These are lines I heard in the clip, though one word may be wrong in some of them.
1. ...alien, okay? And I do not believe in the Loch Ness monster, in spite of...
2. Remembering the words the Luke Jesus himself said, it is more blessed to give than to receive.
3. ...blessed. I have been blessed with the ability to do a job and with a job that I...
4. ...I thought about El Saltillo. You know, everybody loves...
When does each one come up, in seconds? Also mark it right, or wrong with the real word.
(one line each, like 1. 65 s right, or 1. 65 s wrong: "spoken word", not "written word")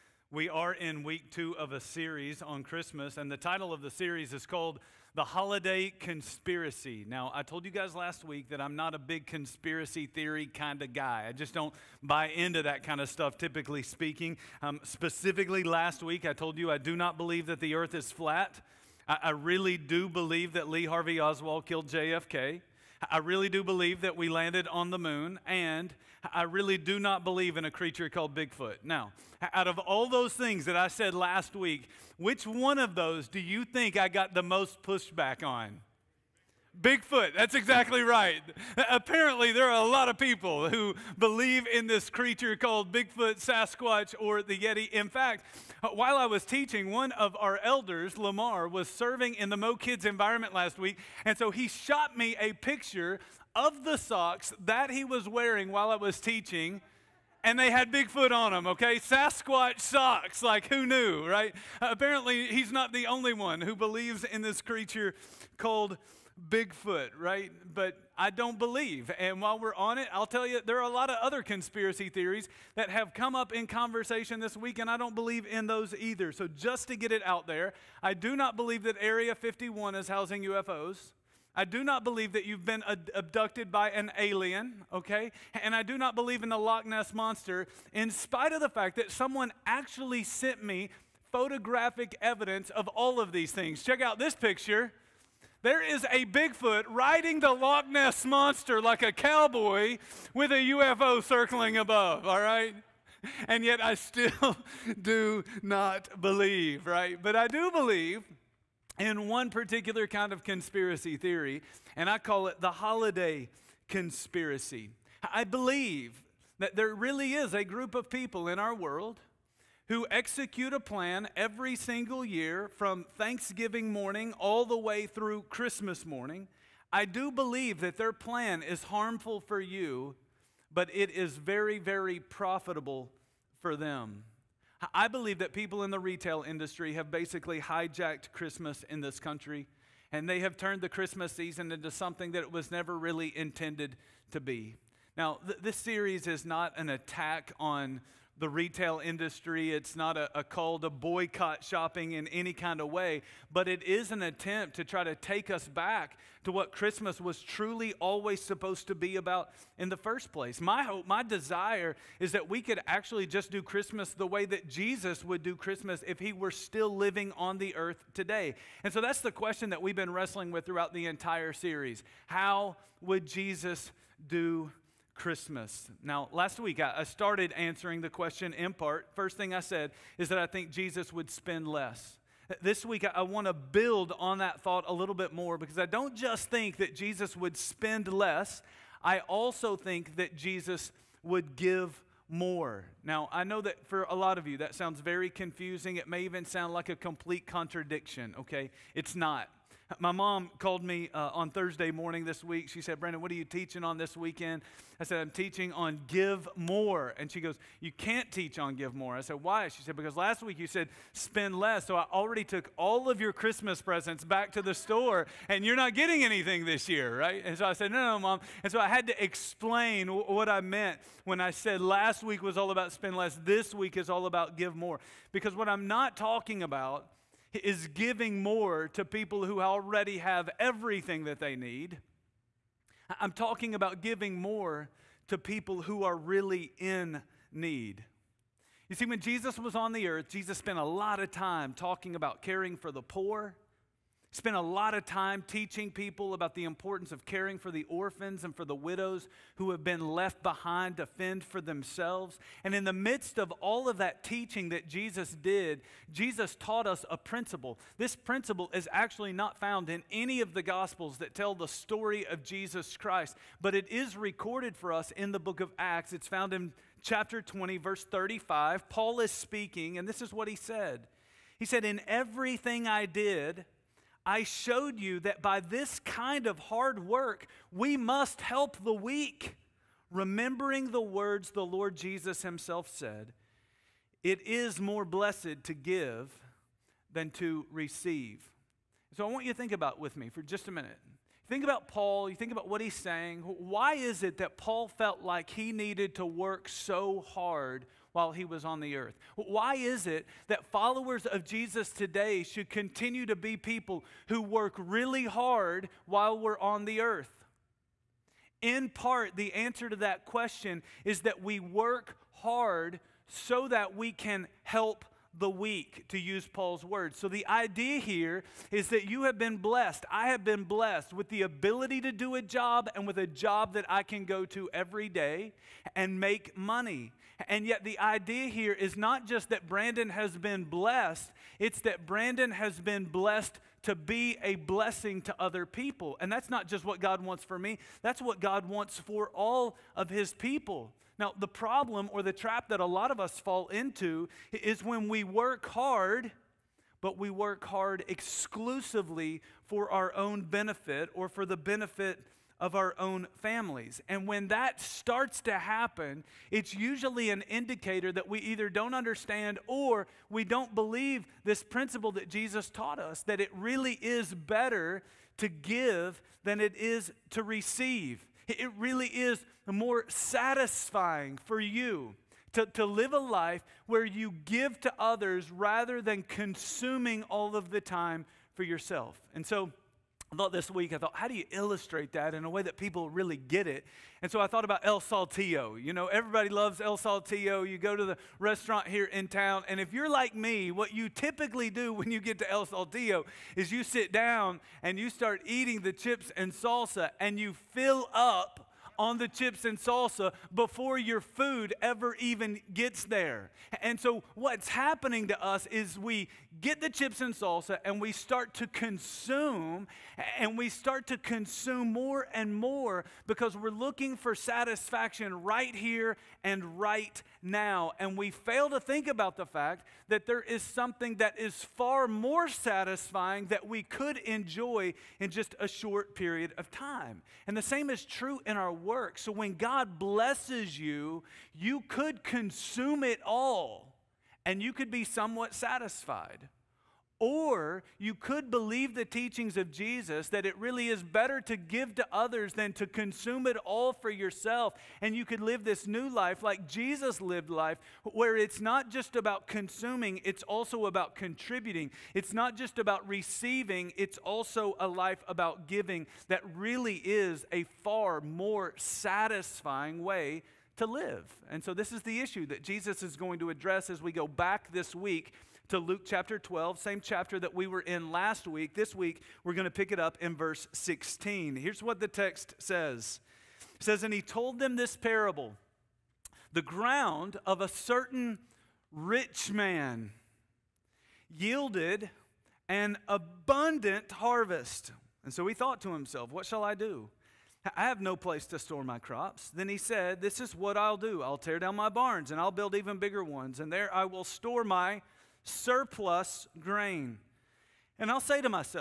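1. 84 s right
2. 280 s wrong: "Lord", not "Luke"
3. 319 s right
4. 384 s right.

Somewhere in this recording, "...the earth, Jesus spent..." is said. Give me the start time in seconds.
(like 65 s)
239 s.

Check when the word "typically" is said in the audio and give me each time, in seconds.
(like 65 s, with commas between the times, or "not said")
13 s, 391 s.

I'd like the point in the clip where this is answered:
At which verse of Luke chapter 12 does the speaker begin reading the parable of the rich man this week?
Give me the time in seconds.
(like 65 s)
470 s.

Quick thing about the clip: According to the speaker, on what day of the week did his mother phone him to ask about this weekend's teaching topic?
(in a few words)
Thursday.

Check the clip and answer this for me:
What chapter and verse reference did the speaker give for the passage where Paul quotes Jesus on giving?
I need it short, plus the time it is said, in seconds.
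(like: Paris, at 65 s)
Chapter 20, verse 35, at 267 s.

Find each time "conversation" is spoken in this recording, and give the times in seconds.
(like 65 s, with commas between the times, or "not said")
73 s.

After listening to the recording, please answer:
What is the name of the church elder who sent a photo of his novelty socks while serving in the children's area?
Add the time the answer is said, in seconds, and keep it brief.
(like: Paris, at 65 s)
Lamar, at 48 s.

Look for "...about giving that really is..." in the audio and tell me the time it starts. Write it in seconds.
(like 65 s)
455 s.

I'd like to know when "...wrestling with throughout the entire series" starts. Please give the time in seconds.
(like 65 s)
170 s.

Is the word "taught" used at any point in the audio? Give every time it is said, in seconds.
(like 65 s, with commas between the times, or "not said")
256 s, 362 s.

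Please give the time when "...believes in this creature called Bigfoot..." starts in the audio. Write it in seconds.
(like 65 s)
63 s.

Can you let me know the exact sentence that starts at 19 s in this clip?
I, I really do believe that Lee Harvey Oswald killed JFK.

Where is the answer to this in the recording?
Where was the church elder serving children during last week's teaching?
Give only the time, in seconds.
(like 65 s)
49 s.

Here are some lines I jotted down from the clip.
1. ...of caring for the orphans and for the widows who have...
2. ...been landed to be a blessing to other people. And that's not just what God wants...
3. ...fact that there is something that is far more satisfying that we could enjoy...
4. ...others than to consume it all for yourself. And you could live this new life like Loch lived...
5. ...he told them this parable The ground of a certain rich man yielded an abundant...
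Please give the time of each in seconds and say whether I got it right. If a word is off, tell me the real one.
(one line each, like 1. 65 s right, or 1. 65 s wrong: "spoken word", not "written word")
1. 247 s right
2. 332 s wrong: "blessed", not "landed"
3. 419 s right
4. 442 s wrong: "Jesus", not "Loch"
5. 474 s right.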